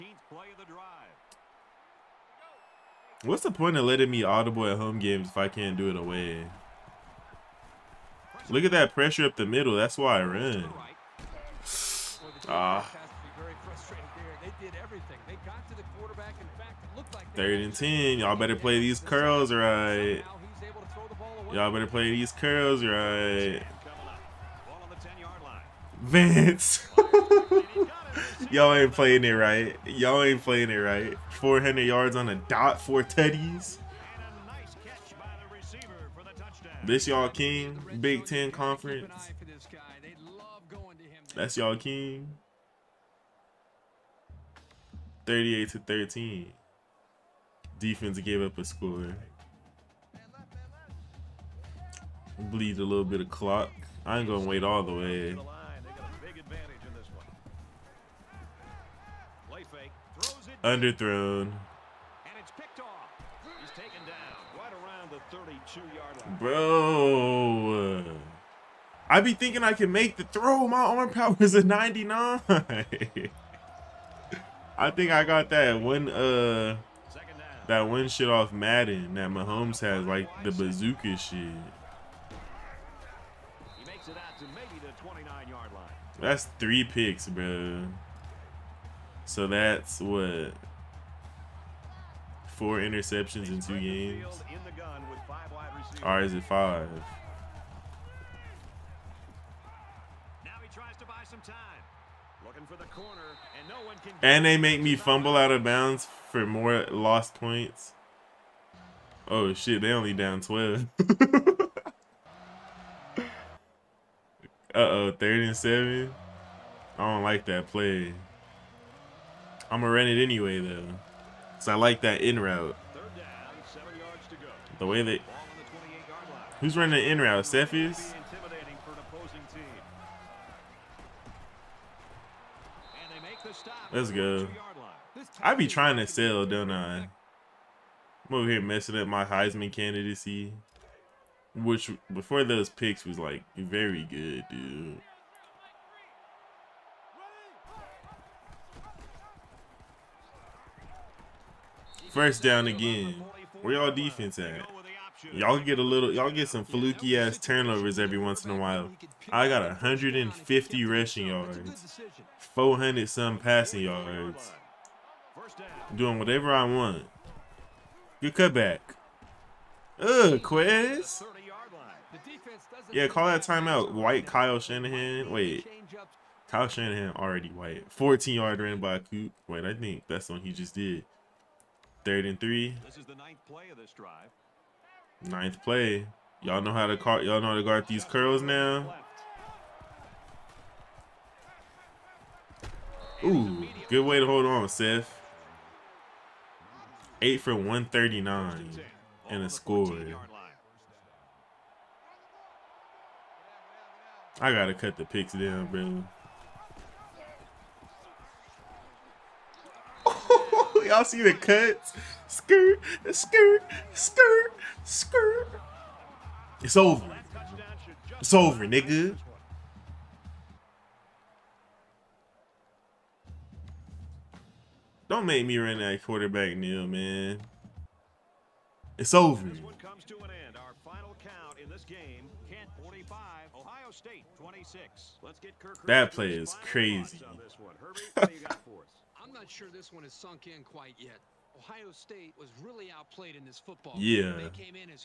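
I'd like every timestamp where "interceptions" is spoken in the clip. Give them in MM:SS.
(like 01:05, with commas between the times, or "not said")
01:32.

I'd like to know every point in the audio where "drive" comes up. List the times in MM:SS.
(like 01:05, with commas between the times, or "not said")
03:03.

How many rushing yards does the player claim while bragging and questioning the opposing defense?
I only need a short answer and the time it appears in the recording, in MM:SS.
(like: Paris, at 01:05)
150, at 02:39.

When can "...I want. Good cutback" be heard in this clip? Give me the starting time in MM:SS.
02:46.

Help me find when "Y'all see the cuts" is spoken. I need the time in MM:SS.
03:30.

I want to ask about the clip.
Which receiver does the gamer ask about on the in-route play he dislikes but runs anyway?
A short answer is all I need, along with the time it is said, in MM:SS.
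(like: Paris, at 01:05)
Cephas, at 02:07.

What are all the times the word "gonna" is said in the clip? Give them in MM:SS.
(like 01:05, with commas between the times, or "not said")
00:54, 01:59.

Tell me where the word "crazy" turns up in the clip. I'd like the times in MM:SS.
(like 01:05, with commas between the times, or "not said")
03:56.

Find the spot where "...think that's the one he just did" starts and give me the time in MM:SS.
02:59.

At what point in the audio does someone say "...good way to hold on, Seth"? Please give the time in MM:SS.
03:13.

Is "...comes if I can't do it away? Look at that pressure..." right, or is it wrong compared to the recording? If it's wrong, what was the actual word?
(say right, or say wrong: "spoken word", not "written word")
wrong: "games", not "comes".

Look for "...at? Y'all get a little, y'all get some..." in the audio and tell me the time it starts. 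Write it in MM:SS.
02:34.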